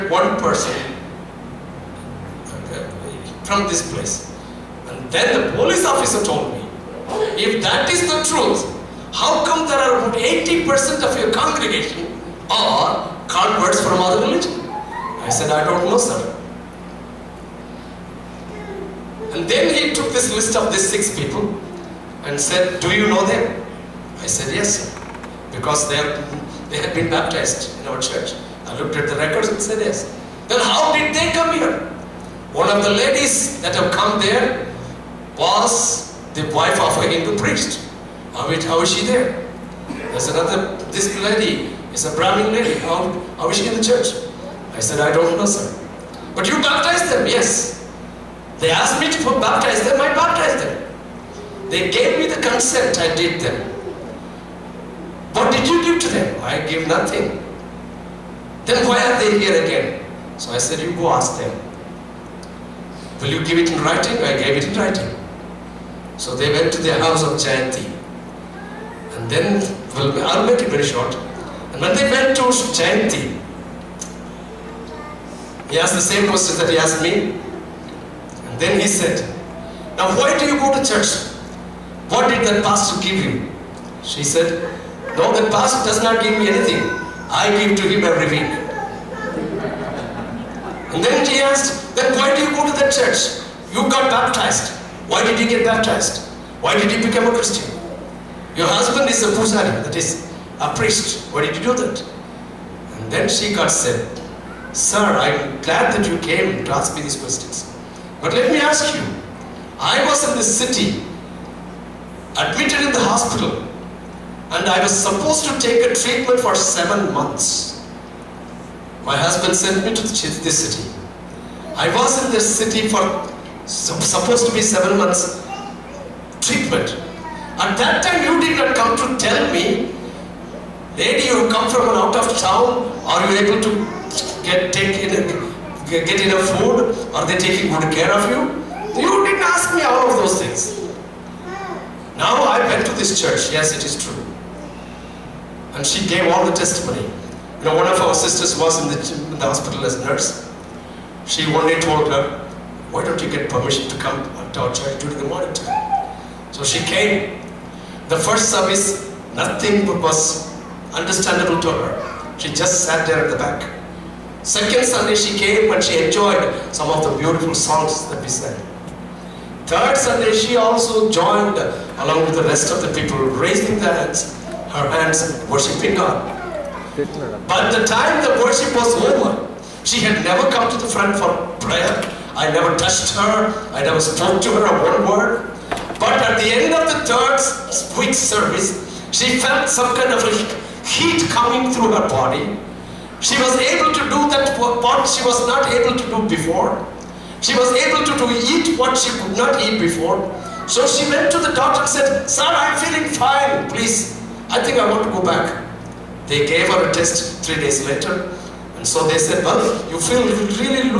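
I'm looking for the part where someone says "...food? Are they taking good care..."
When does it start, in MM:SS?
02:16.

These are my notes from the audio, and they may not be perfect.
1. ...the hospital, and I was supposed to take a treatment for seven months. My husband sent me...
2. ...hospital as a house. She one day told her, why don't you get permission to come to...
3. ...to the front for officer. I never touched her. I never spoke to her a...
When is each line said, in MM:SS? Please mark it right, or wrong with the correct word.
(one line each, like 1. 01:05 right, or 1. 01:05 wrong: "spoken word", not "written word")
1. 01:52 right
2. 02:29 wrong: "nurse", not "house"
3. 03:00 wrong: "prayer", not "officer".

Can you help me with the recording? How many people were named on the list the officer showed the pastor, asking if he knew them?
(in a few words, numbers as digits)
6.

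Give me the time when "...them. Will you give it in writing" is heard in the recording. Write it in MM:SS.
01:01.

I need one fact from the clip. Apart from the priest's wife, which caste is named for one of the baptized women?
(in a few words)
Brahmin.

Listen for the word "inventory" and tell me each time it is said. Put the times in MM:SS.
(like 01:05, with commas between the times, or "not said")
not said.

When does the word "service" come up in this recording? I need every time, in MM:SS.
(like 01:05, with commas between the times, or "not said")
02:38, 03:08.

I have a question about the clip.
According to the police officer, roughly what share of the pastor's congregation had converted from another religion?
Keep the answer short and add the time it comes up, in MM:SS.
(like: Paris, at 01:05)
80%, at 00:10.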